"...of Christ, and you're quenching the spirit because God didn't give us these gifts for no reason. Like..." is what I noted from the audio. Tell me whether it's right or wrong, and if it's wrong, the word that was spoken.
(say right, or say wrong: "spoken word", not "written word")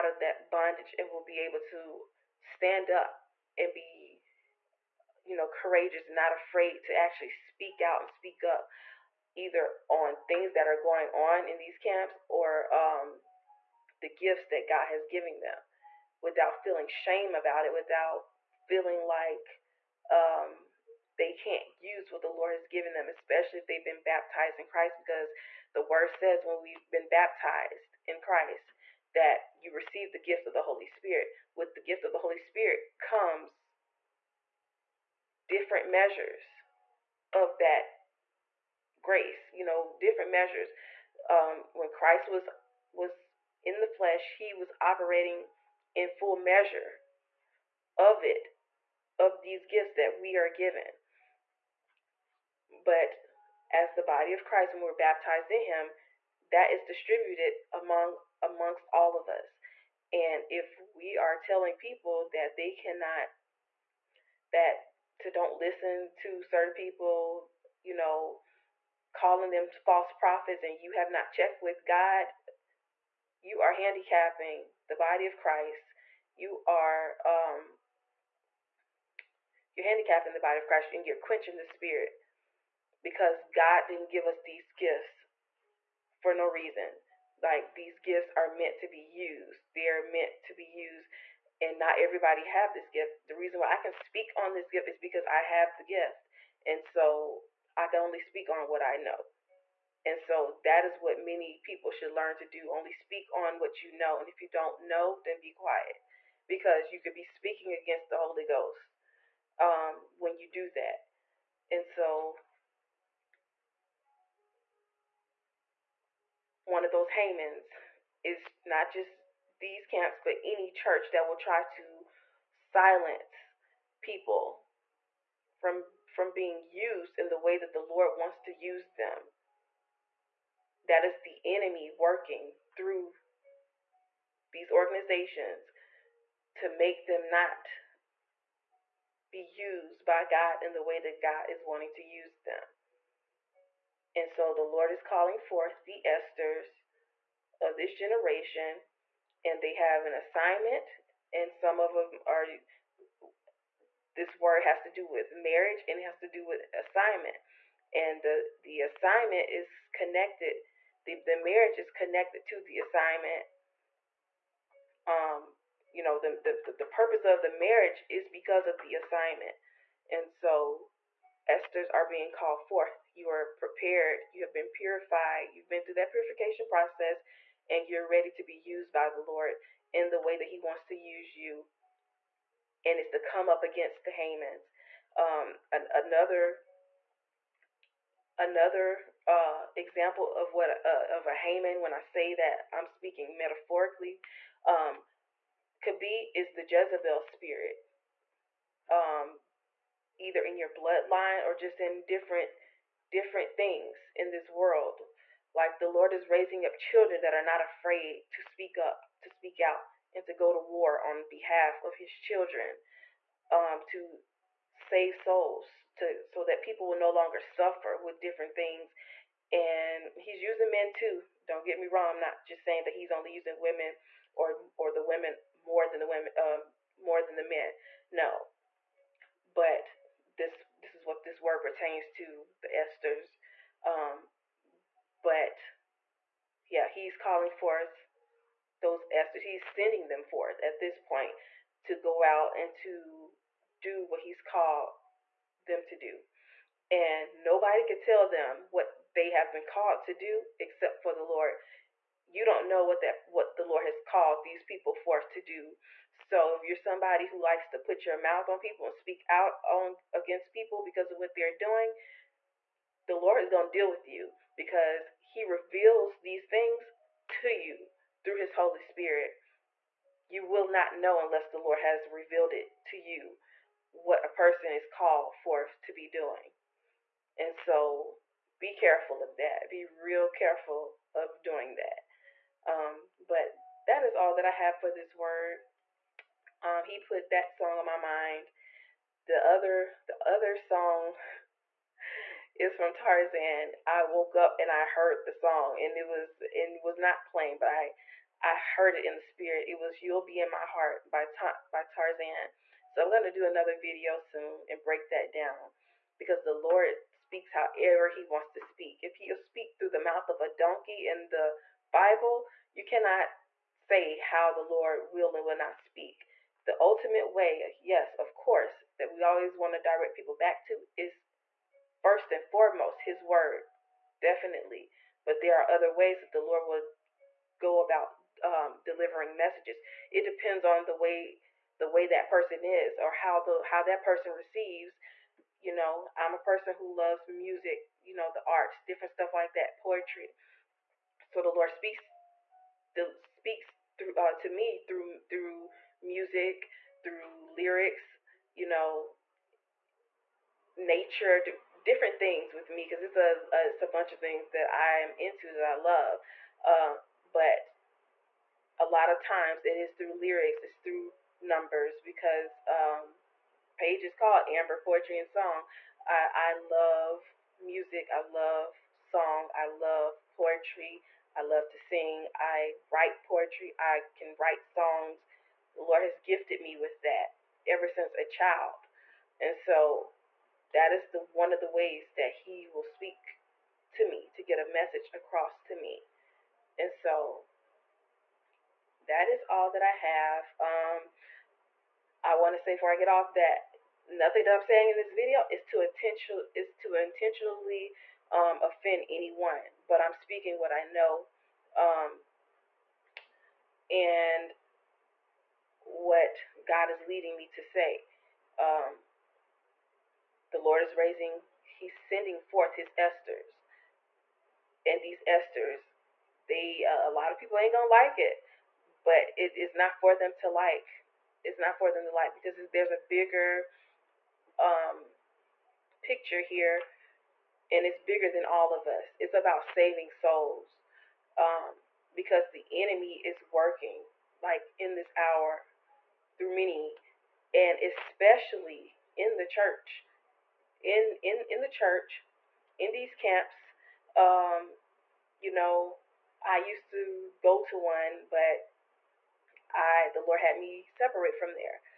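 right.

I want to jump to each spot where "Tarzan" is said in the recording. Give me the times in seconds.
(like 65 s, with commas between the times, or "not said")
292 s, 301 s.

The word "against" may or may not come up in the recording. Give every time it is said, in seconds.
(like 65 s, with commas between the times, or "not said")
107 s, 183 s, 260 s.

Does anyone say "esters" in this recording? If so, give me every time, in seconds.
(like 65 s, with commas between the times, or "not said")
146 s, 171 s, 232 s, 239 s.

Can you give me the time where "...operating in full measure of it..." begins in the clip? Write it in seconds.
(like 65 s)
44 s.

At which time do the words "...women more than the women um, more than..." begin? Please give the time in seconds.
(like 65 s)
225 s.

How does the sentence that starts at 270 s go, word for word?
You will not know unless the Lord has revealed it to you what a person is called for to be doing.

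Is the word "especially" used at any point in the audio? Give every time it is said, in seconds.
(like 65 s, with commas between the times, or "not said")
23 s, 437 s.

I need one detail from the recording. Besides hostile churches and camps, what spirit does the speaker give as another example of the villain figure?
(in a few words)
Jezebel spirit.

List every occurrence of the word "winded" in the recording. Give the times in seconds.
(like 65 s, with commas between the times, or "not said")
not said.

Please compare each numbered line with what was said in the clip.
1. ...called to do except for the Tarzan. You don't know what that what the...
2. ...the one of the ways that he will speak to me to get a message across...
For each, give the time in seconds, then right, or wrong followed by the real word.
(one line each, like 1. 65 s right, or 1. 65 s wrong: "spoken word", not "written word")
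1. 249 s wrong: "Lord", not "Tarzan"
2. 381 s right.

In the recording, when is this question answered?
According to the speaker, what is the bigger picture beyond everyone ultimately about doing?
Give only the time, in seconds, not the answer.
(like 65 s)
429 s.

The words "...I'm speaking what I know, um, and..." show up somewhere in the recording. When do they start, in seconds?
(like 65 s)
399 s.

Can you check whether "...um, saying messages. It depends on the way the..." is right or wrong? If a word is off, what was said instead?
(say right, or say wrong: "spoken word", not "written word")
wrong: "delivering", not "saying".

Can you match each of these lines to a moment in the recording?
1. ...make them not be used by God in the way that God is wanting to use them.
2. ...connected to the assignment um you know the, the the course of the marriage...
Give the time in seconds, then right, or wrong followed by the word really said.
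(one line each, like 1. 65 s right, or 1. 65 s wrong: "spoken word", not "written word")
1. 136 s right
2. 161 s wrong: "purpose", not "course".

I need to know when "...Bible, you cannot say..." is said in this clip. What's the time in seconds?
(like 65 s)
311 s.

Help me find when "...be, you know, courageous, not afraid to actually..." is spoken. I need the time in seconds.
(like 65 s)
3 s.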